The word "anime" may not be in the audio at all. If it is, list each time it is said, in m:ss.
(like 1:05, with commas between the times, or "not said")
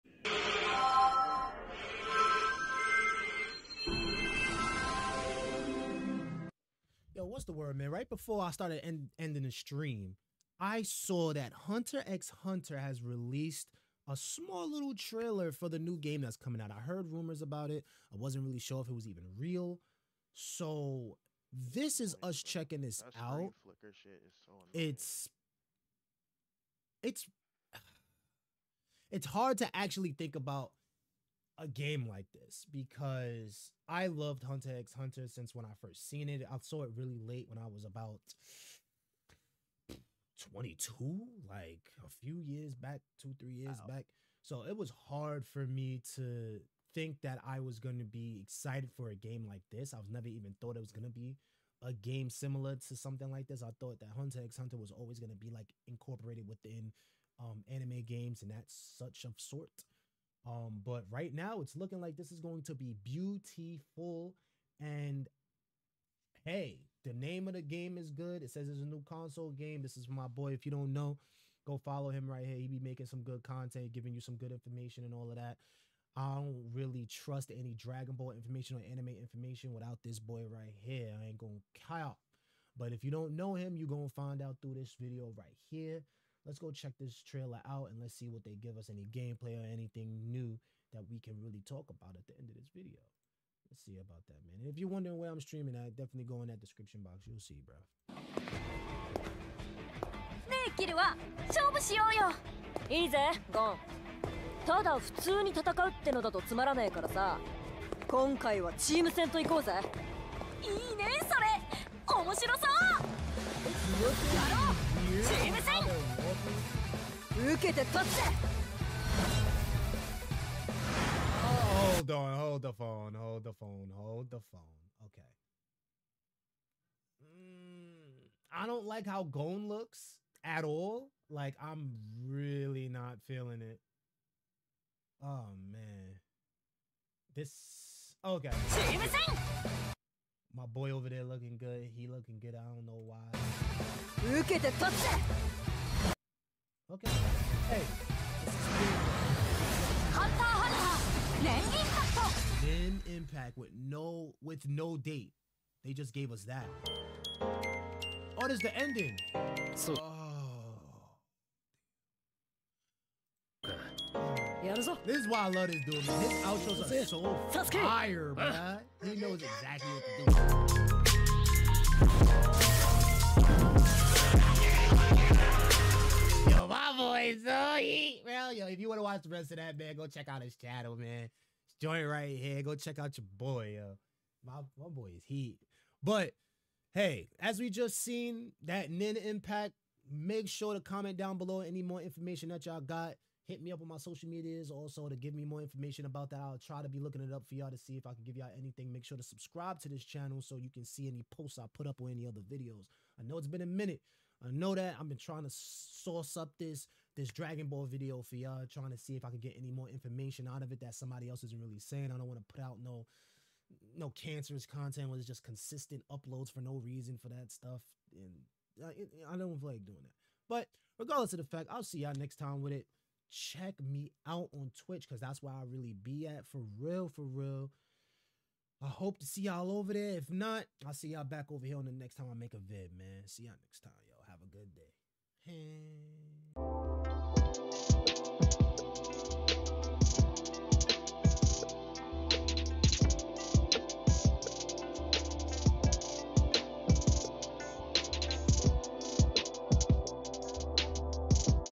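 0:57, 1:18.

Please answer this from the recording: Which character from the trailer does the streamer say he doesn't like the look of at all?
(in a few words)
Gon.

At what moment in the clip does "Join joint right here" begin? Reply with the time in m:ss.
3:01.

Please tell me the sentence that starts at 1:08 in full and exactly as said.
It says it's a new console game.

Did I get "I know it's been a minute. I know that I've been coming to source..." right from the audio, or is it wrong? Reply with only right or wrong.
wrong.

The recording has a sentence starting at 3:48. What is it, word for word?
I hope to see y'all over there.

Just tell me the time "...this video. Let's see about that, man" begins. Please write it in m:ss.
1:32.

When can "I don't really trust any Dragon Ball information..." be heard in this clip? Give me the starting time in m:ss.
1:16.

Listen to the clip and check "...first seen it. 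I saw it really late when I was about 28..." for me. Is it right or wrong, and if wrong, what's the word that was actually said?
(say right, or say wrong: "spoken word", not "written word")
wrong: "22", not "28".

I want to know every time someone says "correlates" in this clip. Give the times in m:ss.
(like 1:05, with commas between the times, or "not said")
not said.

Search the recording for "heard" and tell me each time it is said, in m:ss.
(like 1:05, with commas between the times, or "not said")
0:16.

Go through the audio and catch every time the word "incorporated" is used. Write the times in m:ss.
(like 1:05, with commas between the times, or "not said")
0:55.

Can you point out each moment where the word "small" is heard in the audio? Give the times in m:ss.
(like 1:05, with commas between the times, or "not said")
0:14.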